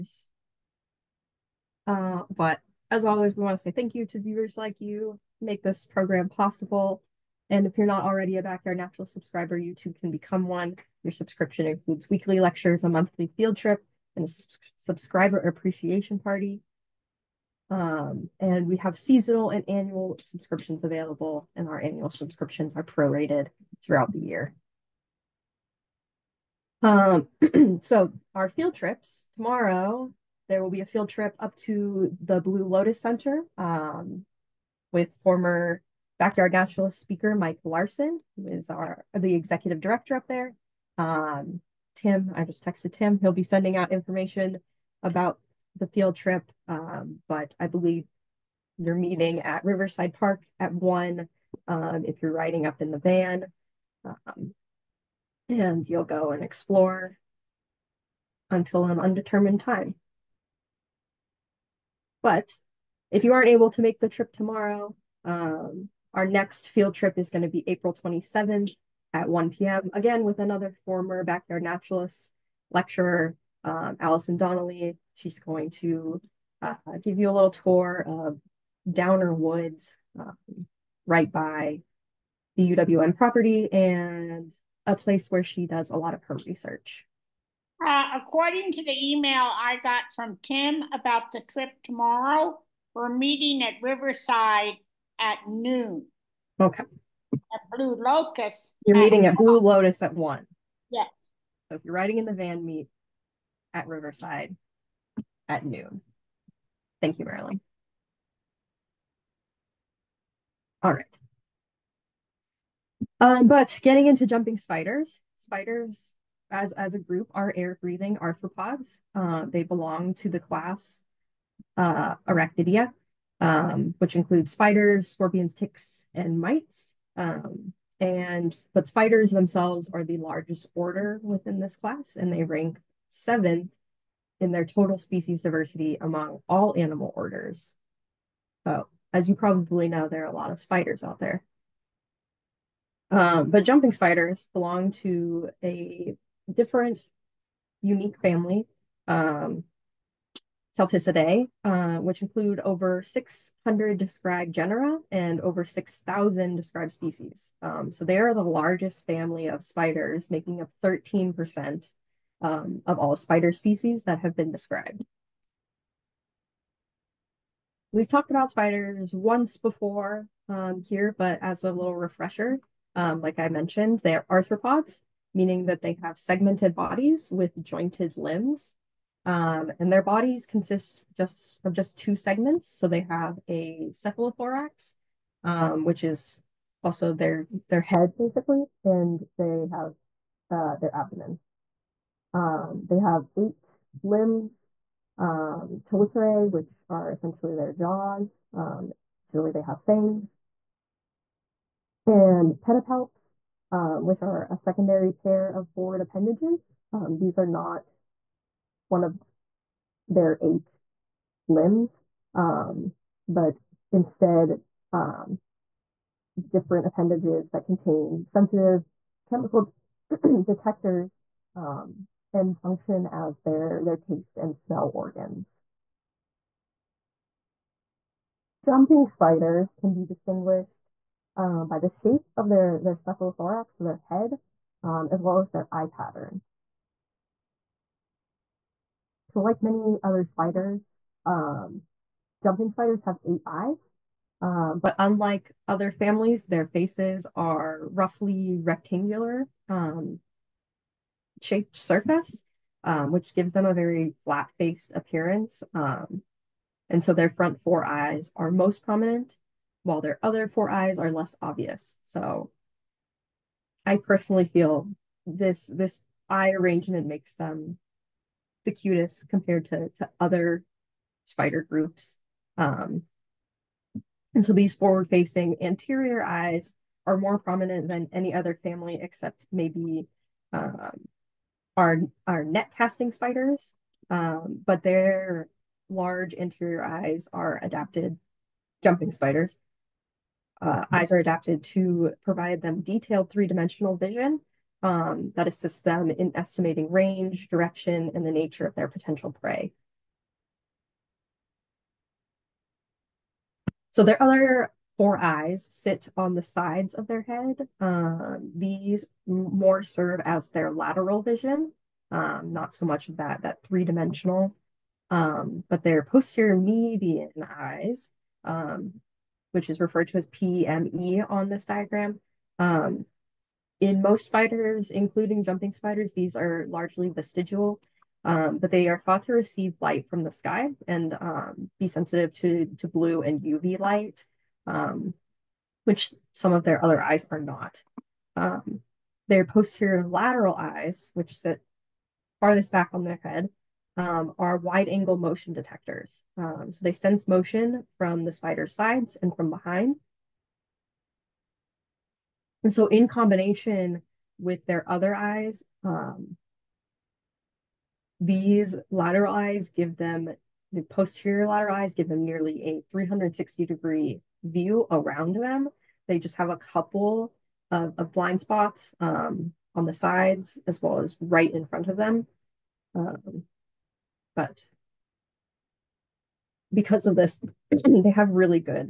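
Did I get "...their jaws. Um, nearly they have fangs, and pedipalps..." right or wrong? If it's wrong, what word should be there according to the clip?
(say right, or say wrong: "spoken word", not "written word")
wrong: "usually", not "nearly".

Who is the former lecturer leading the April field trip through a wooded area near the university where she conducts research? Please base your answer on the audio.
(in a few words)
Allison Donnelly.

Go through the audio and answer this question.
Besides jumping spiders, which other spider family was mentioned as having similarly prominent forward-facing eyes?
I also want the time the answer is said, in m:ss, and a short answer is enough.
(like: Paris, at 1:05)
net casting spiders, at 4:42.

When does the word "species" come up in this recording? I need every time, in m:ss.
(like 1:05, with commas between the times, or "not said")
2:14, 2:36, 2:43.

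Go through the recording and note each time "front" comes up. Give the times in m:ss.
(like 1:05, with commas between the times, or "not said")
4:17, 6:11.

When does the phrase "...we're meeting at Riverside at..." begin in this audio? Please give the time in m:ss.
1:32.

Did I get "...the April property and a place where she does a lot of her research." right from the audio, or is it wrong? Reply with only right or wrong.
wrong.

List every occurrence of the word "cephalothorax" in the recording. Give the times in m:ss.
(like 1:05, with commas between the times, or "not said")
3:03, 3:52.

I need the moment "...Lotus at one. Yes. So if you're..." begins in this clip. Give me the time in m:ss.
1:39.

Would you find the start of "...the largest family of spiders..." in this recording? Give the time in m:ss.
2:38.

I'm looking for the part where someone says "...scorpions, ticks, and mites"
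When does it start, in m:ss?
2:05.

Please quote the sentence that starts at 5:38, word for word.
Um, their posterior lateral eyes, which sit farthest back on their head, um, are wide angle motion detectors.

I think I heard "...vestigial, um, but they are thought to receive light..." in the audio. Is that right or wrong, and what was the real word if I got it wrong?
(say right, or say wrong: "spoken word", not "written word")
right.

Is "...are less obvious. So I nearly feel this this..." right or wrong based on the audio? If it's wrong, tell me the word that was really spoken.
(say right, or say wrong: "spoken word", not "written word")
wrong: "personally", not "nearly".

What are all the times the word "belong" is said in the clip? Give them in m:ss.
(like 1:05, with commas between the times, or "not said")
1:59, 2:24.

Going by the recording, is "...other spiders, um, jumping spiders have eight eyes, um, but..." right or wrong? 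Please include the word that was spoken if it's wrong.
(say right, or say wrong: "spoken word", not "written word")
right.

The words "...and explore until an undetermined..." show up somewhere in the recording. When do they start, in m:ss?
0:56.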